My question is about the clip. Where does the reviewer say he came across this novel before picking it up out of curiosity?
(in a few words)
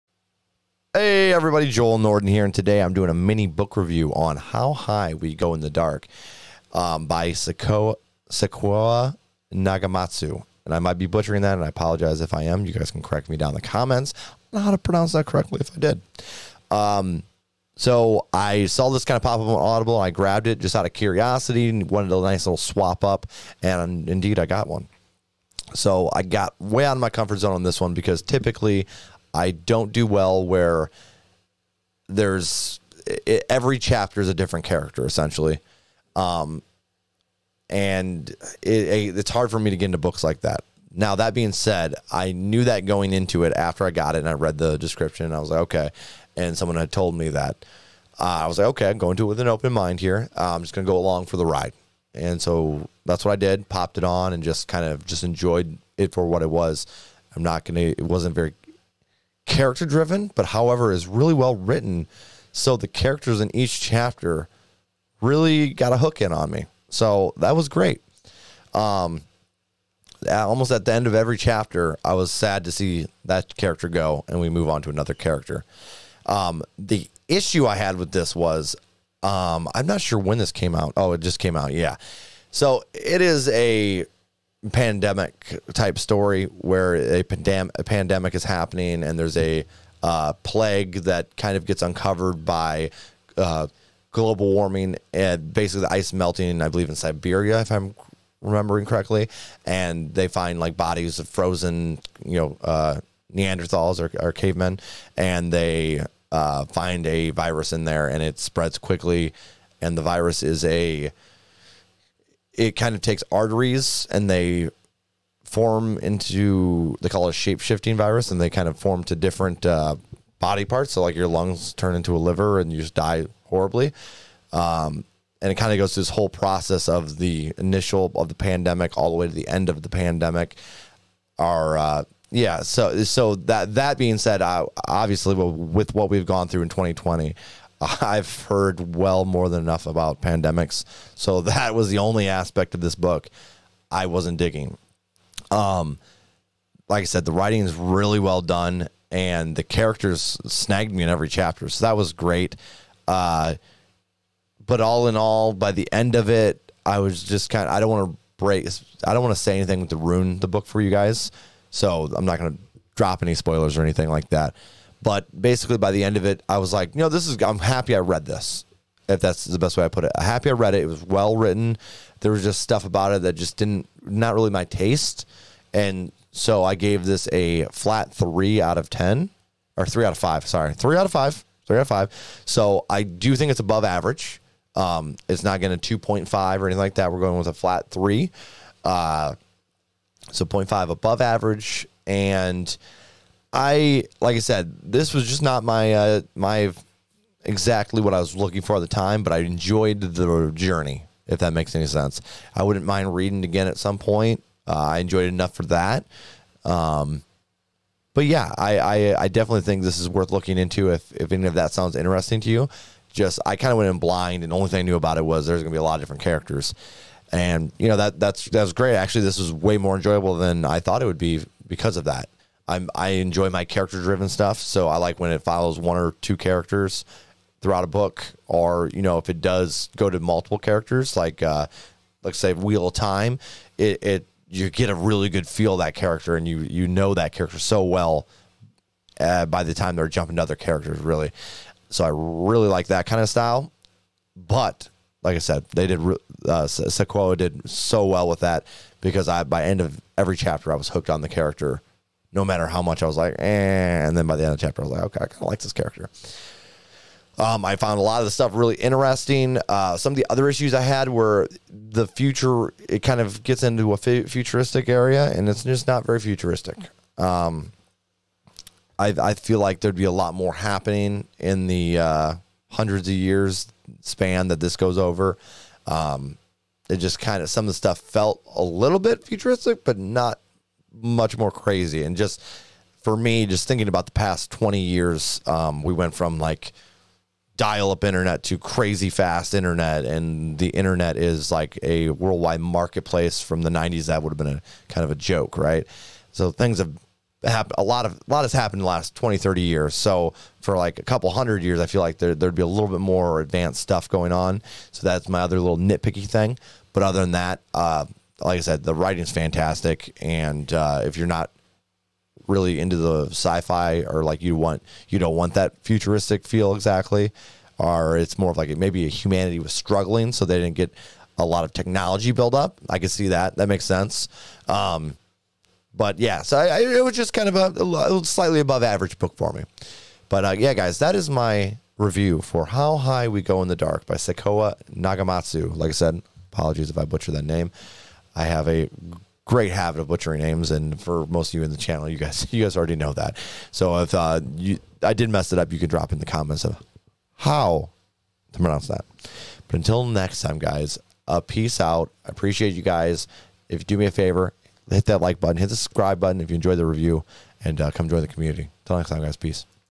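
Audible.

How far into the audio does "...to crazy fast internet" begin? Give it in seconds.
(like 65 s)
288 s.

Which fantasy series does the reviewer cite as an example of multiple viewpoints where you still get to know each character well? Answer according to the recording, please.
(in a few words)
Wheel of Time.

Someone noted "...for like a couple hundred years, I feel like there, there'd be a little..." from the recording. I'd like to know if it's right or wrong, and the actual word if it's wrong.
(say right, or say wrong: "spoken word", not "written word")
right.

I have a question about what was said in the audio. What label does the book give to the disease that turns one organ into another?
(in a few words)
shape shifting virus.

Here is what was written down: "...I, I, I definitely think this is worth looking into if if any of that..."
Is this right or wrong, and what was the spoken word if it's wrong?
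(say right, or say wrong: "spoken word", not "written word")
right.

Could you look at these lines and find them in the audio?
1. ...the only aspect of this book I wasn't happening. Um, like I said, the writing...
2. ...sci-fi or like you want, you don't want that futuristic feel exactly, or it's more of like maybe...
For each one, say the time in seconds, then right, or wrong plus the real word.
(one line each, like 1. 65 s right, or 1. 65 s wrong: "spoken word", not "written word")
1. 141 s wrong: "digging", not "happening"
2. 313 s right.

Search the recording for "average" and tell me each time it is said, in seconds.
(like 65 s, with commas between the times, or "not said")
183 s, 191 s, 328 s.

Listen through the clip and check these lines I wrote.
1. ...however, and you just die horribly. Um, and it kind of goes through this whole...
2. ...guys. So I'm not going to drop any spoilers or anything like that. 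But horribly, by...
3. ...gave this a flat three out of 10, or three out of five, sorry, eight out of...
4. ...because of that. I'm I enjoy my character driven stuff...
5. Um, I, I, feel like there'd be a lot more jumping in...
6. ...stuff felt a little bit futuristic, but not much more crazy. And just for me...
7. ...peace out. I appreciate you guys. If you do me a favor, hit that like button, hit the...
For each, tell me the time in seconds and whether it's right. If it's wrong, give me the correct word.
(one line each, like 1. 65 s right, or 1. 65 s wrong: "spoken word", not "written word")
1. 122 s wrong: "liver", not "however"
2. 160 s wrong: "basically", not "horribly"
3. 176 s wrong: "three", not "eight"
4. 221 s right
5. 267 s wrong: "happening", not "jumping"
6. 277 s right
7. 351 s right.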